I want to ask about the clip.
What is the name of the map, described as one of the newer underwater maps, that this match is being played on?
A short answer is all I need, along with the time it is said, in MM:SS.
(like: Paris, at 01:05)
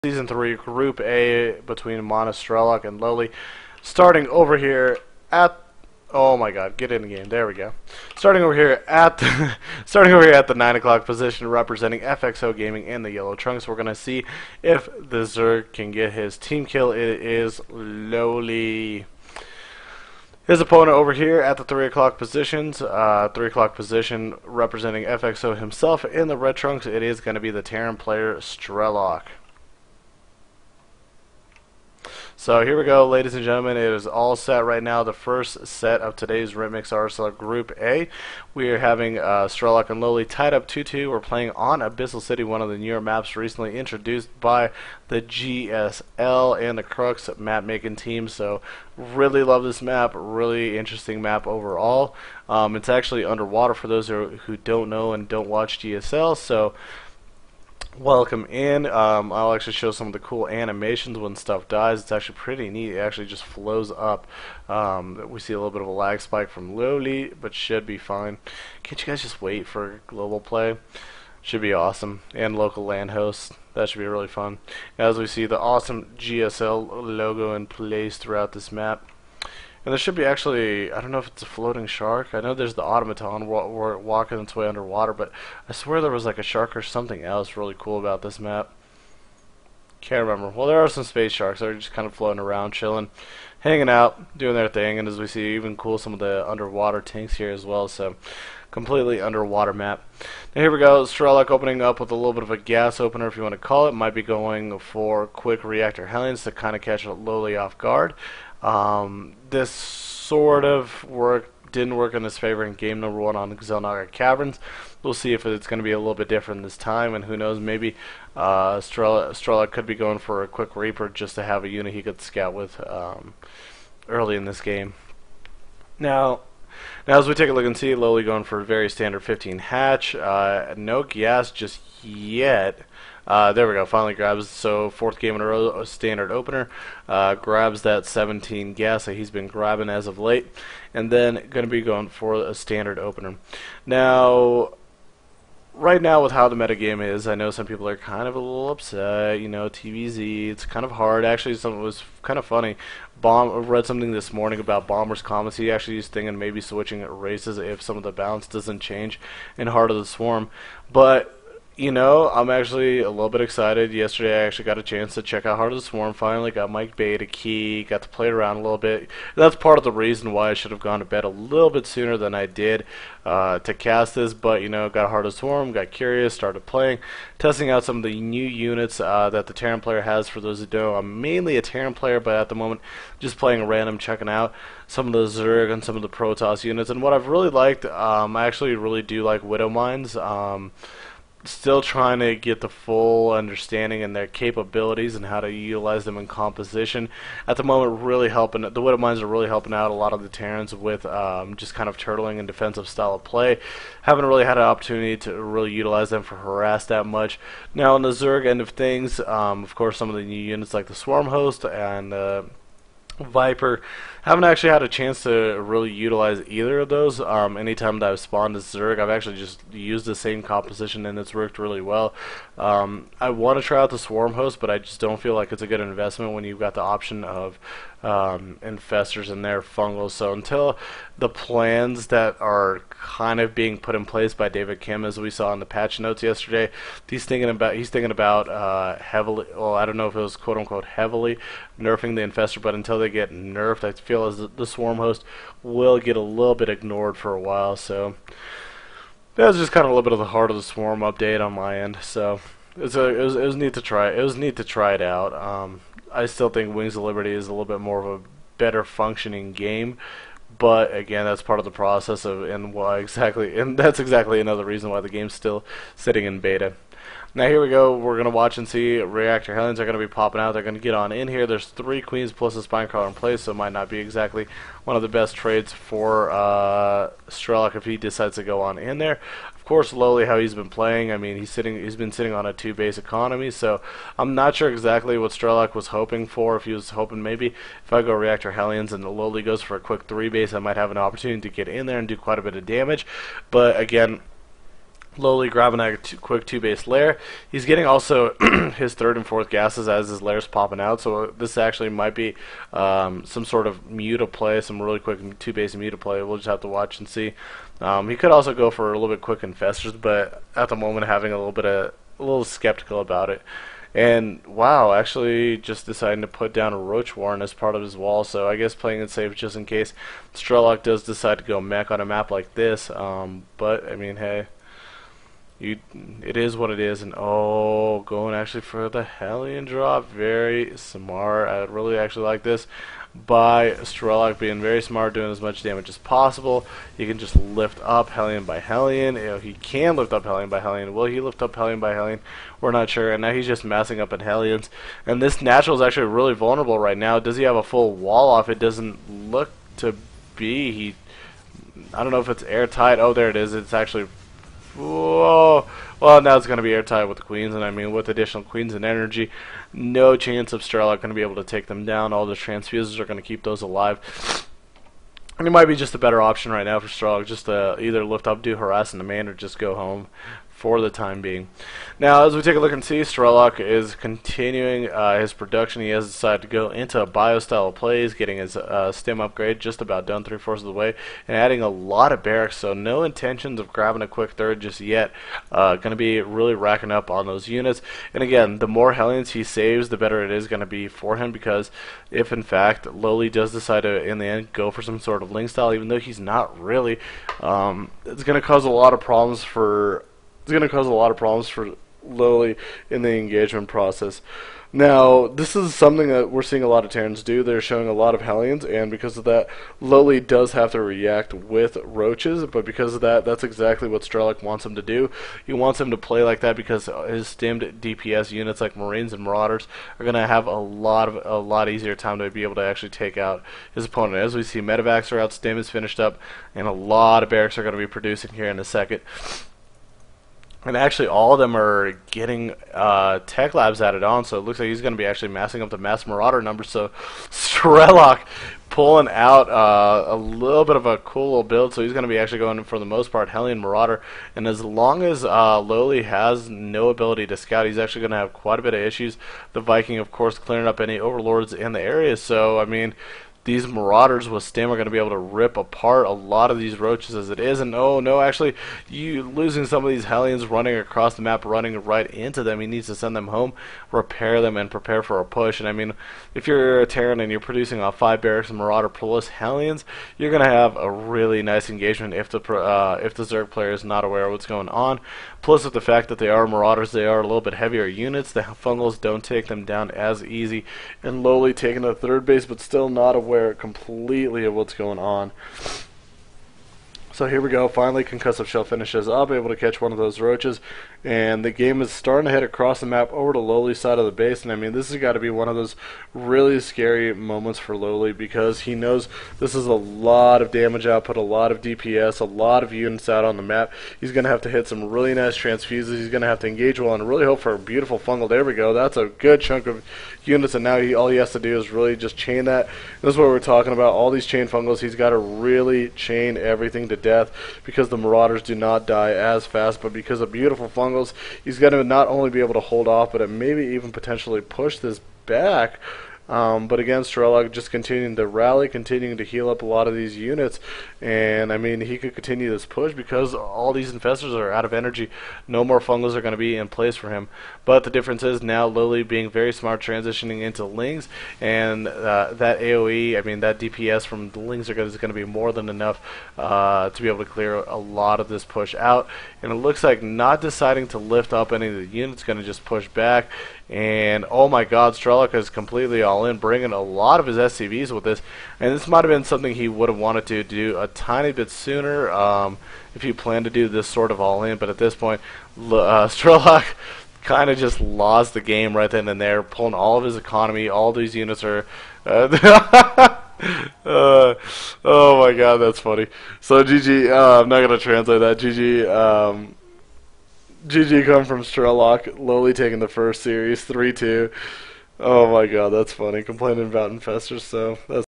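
Abyssal City, at 00:41.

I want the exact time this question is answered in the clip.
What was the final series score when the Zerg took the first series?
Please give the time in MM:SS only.
09:43.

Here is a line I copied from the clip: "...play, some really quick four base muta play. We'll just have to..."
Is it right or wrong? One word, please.
wrong.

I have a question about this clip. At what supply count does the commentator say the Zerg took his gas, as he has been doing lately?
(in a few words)
17.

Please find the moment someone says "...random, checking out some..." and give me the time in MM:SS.
03:03.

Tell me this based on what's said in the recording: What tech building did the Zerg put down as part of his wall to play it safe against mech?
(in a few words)
Roach Warren.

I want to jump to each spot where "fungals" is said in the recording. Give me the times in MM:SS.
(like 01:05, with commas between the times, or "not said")
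03:49, 07:58, 08:27, 08:34, 08:40, 08:55.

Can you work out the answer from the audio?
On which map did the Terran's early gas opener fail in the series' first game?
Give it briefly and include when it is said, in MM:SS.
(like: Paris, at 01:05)
Xel'Naga Caverns, at 01:53.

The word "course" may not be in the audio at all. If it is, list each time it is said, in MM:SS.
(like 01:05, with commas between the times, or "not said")
03:29, 04:39, 07:30.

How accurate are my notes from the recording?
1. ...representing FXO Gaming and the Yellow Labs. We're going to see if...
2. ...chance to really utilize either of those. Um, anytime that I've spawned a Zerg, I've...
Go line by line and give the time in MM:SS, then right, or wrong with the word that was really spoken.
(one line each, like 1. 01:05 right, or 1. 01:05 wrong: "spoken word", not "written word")
1. 00:11 wrong: "Trunks", not "Labs"
2. 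03:34 right.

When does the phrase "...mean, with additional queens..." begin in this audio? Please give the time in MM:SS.
05:57.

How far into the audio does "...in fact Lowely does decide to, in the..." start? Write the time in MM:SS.
06:32.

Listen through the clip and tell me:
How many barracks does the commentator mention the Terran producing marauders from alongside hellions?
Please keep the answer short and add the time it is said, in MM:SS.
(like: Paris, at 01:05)
5, at 07:47.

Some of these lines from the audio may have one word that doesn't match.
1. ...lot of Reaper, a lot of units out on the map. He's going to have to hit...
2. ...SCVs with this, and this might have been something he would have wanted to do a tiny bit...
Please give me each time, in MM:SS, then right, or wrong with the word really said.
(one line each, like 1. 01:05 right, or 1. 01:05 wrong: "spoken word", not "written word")
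1. 08:21 wrong: "DPS", not "Reaper"
2. 09:17 right.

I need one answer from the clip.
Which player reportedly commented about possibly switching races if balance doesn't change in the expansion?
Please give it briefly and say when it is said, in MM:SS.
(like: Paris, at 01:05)
Bomber, at 02:34.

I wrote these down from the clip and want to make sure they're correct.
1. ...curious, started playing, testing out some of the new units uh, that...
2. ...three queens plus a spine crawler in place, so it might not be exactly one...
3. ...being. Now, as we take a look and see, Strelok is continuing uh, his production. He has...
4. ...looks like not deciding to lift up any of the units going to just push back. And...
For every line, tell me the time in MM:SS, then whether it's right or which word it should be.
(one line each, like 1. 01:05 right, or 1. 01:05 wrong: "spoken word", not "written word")
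1. 02:55 right
2. 04:31 right
3. 06:11 right
4. 09:09 right.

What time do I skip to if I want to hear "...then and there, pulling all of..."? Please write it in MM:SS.
09:28.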